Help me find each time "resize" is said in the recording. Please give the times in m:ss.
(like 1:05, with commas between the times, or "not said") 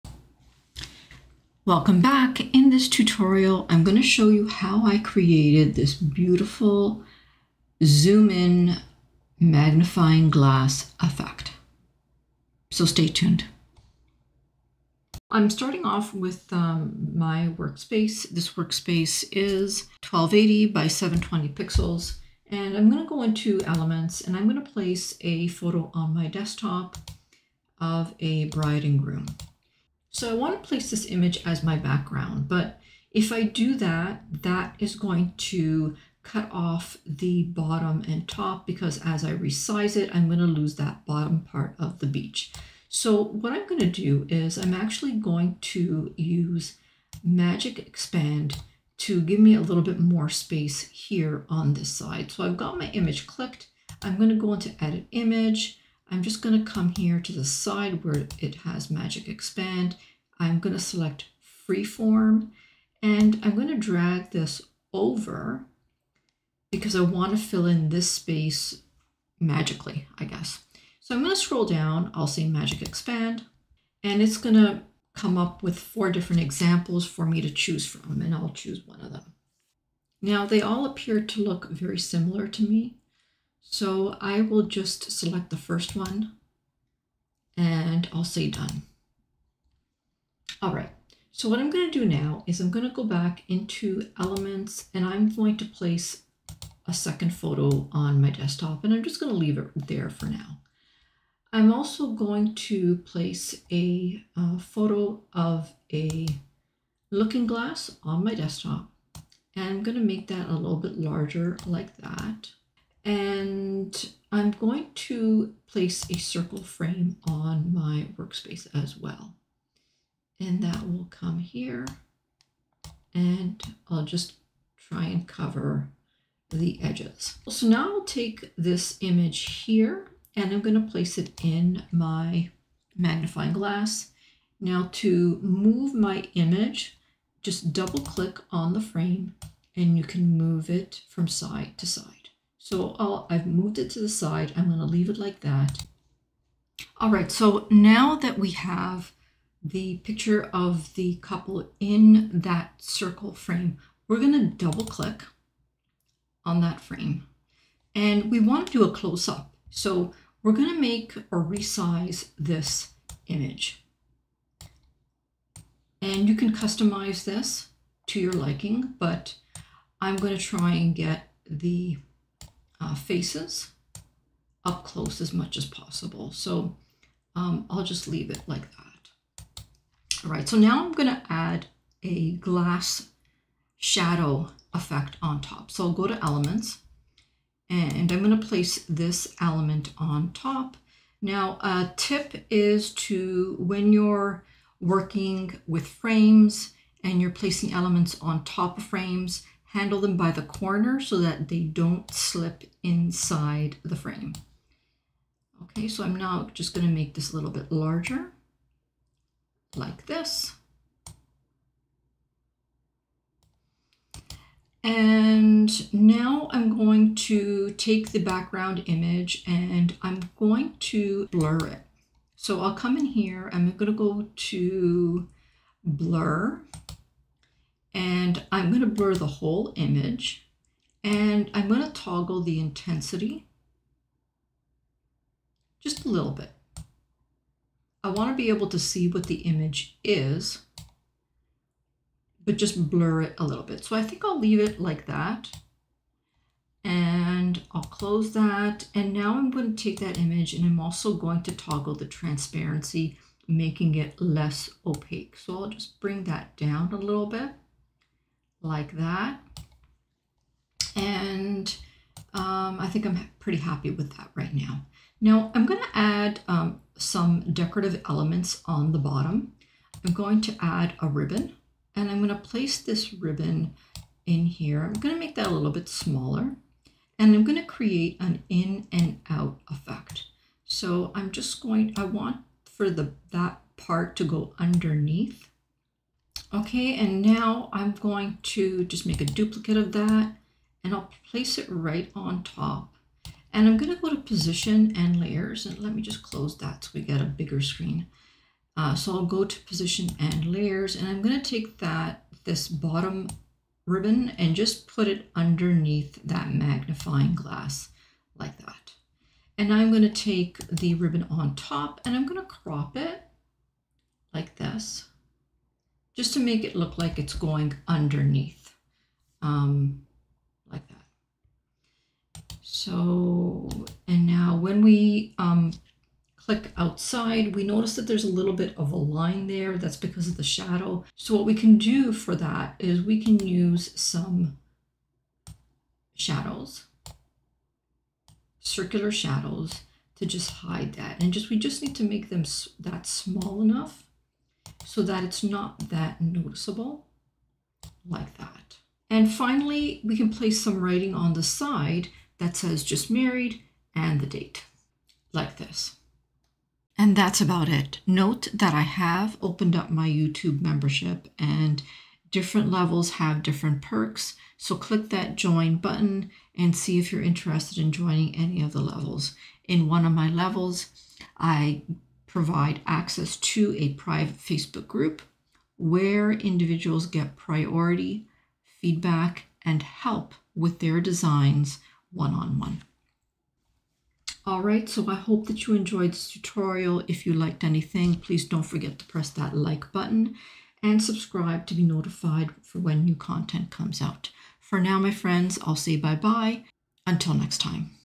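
0:39, 2:41.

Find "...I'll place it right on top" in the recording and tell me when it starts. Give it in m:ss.
4:50.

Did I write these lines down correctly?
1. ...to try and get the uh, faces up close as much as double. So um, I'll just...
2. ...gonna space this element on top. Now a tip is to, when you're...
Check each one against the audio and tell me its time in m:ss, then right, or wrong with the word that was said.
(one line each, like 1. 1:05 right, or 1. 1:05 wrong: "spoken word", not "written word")
1. 2:50 wrong: "possible", not "double"
2. 3:08 wrong: "place", not "space".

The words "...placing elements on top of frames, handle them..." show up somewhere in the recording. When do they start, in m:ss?
3:17.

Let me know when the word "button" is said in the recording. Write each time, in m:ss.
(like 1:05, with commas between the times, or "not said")
6:05, 6:29.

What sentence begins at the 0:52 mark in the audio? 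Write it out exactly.
So I've got my image clicked.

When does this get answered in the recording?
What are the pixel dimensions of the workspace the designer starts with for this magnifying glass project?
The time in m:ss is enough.
0:20.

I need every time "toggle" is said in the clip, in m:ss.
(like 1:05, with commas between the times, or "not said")
3:51, 4:11.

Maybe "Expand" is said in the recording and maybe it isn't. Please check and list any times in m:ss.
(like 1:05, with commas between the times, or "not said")
0:47, 0:59, 1:12.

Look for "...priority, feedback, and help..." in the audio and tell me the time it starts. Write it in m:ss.
6:17.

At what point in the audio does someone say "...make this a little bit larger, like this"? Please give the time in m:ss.
3:26.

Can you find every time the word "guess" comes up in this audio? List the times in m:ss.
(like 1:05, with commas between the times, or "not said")
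1:10.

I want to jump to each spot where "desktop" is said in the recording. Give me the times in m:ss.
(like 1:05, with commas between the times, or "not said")
0:26, 1:38, 1:48.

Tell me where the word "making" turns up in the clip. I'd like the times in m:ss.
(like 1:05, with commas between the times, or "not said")
4:13.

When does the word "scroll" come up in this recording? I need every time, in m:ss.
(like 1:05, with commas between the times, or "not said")
1:11.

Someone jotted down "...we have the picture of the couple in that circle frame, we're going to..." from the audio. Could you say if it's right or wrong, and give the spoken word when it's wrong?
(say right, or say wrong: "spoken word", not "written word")
right.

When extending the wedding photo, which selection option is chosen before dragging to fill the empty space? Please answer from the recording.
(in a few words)
Freeform.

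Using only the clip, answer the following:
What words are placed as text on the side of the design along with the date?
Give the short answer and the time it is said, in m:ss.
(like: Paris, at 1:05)
just married, at 5:52.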